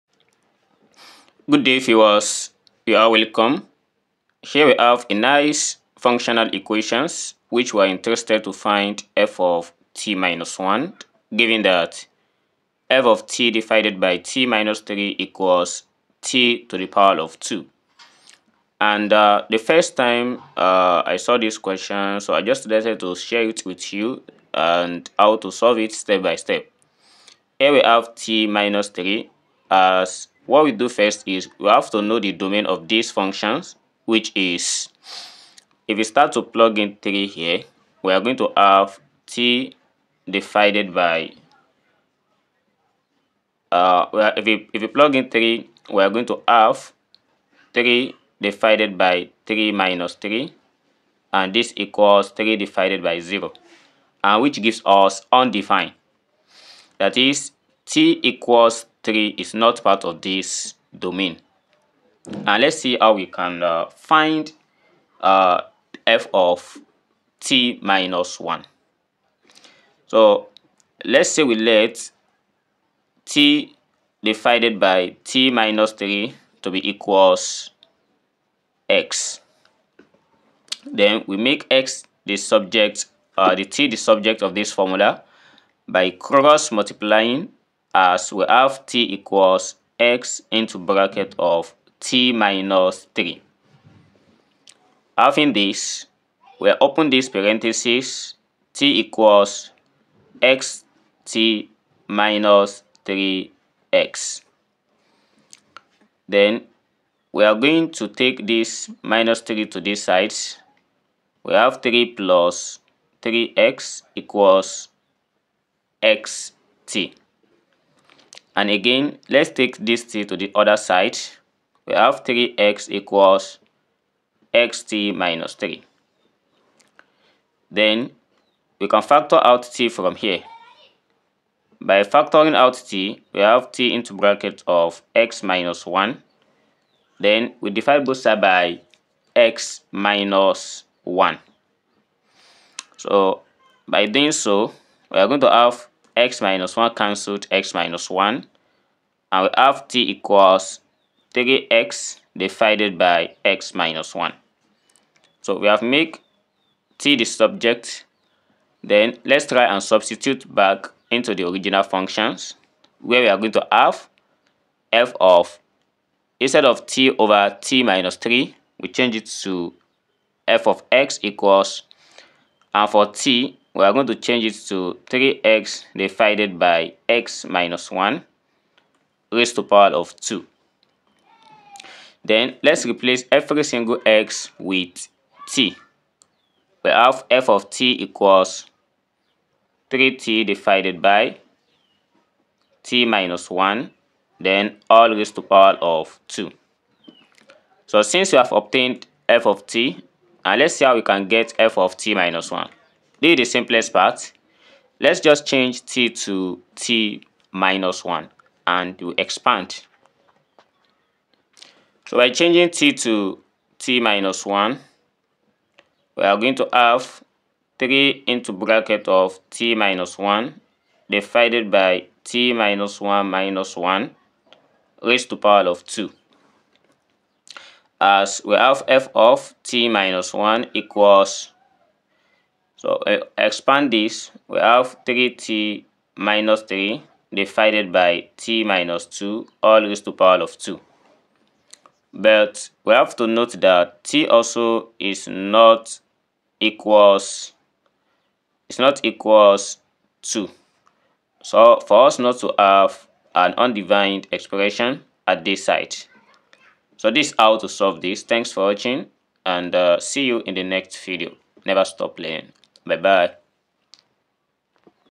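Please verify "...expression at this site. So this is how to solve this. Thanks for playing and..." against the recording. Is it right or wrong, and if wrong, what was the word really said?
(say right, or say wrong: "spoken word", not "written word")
wrong: "watching", not "playing".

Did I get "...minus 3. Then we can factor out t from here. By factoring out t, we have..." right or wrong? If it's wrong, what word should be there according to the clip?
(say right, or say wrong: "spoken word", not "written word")
right.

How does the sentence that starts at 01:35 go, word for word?
Having this, we open this parenthesis t equals x t minus 3x.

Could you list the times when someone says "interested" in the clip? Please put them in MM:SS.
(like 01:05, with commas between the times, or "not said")
00:07.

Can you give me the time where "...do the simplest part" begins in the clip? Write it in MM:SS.
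03:23.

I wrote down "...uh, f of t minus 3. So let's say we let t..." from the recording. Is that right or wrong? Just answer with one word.
wrong.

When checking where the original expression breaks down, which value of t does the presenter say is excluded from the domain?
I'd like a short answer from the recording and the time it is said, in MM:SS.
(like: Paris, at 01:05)
3, at 00:57.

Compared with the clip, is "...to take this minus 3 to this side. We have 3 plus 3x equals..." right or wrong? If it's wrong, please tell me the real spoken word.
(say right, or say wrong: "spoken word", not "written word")
right.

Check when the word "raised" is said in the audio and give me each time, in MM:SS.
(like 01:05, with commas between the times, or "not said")
02:59, 03:15, 03:45, 03:59.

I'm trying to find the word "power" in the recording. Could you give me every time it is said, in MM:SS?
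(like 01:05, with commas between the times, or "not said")
00:16, 02:59, 03:15, 03:45, 04:00.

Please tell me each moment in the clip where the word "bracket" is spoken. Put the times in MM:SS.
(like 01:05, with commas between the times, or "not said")
01:30, 02:14, 03:38.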